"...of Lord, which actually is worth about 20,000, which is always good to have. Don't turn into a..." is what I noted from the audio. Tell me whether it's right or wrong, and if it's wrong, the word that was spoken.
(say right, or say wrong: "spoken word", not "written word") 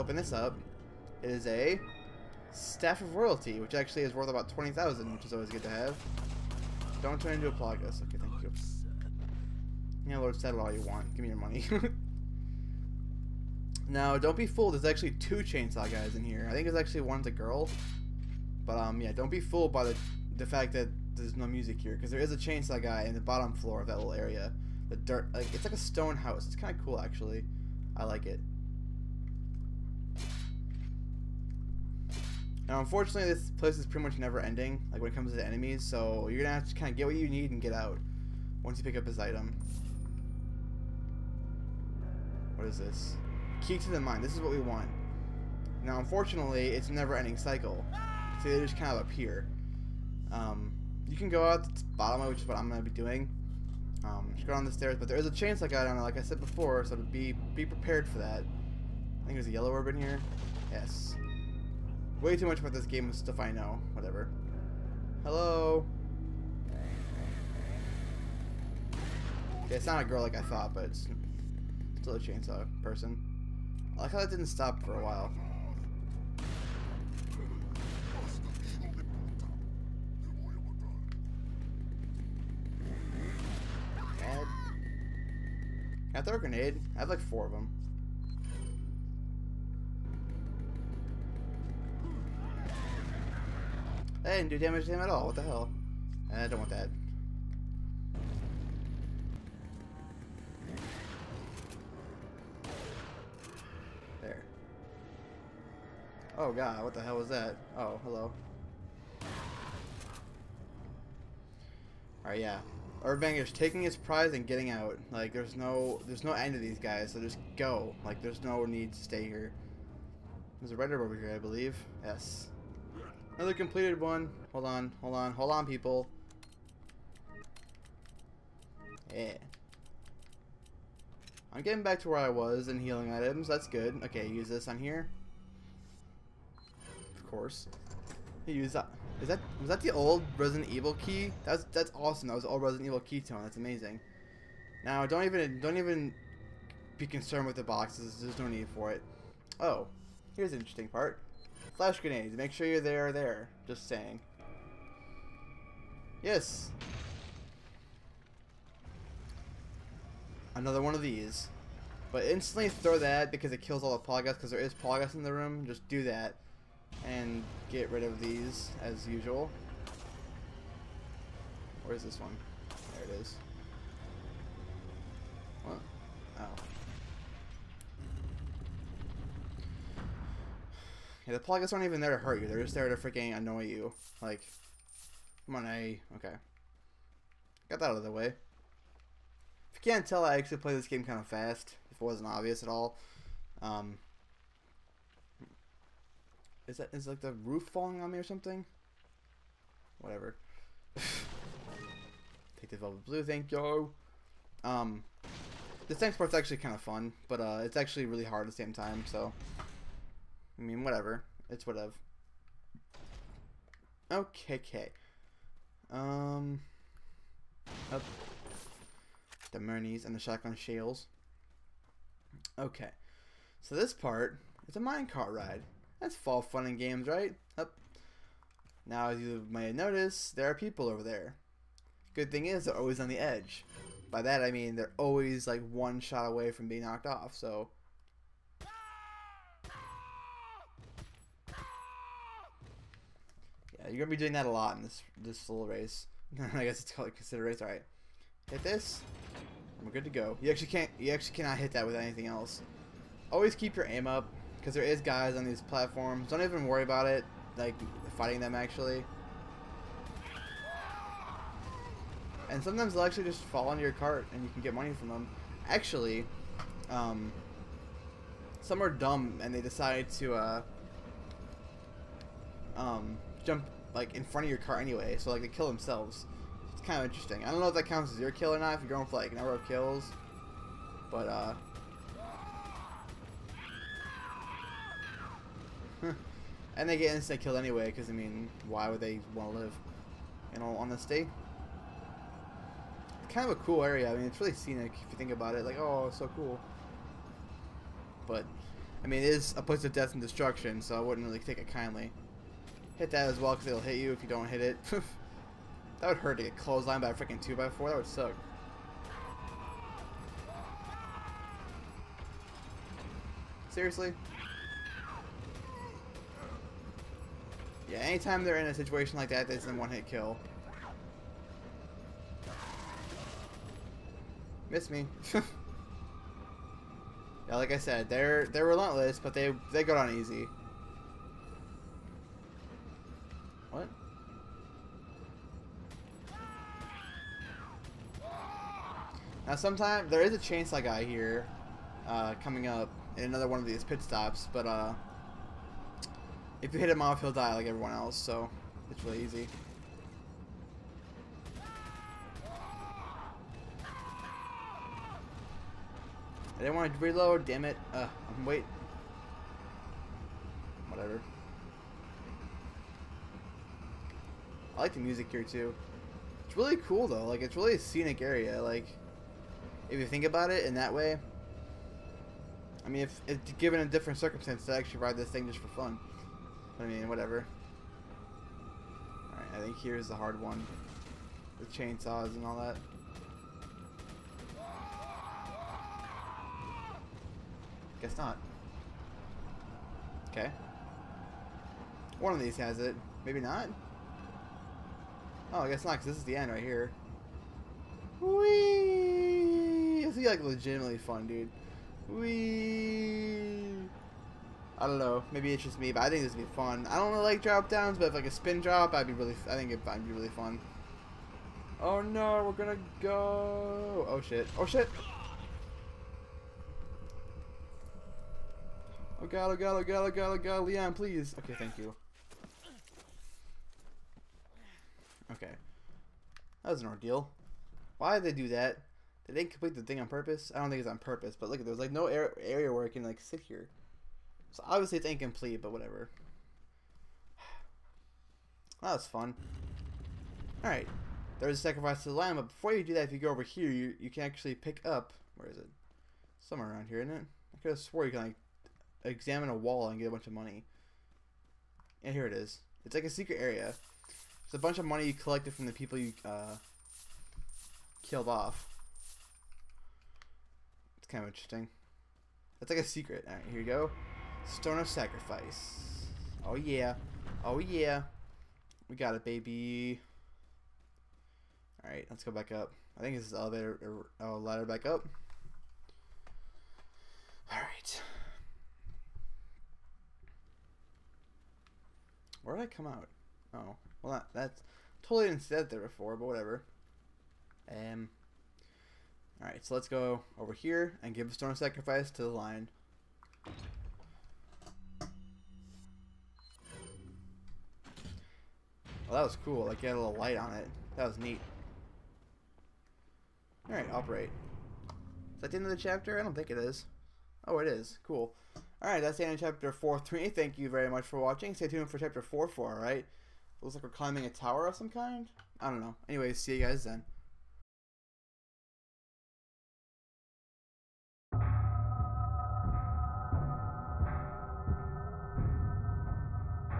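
wrong: "Royalty", not "Lord".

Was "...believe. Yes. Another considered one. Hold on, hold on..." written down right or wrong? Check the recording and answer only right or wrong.
wrong.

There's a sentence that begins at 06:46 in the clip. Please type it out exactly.
I don't really like drop downs, but if like a spin drop, I'd be really.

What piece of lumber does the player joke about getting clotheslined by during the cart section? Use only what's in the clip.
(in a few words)
2x4.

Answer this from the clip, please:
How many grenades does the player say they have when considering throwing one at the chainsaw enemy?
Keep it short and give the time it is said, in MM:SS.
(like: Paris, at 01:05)
4, at 01:27.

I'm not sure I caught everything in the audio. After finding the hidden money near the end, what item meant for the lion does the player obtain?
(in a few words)
Stone of Sacrifice.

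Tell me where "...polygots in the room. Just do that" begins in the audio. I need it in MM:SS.
02:44.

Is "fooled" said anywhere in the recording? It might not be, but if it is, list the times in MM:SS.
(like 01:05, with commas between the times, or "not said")
00:14, 00:19.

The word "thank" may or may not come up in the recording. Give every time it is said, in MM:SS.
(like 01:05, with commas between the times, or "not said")
00:08, 03:23, 07:01, 08:30.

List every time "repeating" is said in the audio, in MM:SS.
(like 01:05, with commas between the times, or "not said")
not said.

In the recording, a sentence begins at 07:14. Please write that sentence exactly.
So obviously it's incomplete, but whatever.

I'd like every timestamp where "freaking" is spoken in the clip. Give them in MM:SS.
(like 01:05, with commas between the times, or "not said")
03:02, 05:07.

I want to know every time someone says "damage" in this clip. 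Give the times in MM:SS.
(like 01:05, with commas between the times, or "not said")
01:34.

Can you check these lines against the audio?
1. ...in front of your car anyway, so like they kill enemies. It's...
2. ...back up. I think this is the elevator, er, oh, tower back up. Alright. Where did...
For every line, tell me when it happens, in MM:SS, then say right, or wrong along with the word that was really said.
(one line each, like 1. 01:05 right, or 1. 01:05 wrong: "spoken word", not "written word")
1. 04:34 wrong: "themselves", not "enemies"
2. 07:52 wrong: "ladder", not "tower".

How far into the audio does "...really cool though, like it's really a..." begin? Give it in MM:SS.
06:06.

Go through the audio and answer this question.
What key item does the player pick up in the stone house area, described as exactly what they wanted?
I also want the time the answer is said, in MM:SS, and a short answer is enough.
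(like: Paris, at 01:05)
Key to the mine, at 00:43.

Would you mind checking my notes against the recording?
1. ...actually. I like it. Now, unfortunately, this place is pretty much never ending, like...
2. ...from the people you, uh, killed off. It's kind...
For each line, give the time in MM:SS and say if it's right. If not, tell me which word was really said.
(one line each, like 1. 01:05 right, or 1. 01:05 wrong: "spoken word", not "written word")
1. 00:26 right
2. 07:35 right.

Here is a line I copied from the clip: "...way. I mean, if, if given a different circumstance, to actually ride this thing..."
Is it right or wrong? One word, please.
right.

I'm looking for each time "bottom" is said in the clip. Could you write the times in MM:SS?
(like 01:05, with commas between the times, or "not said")
00:23, 00:51.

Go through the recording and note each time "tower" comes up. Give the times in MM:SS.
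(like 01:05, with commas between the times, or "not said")
08:34.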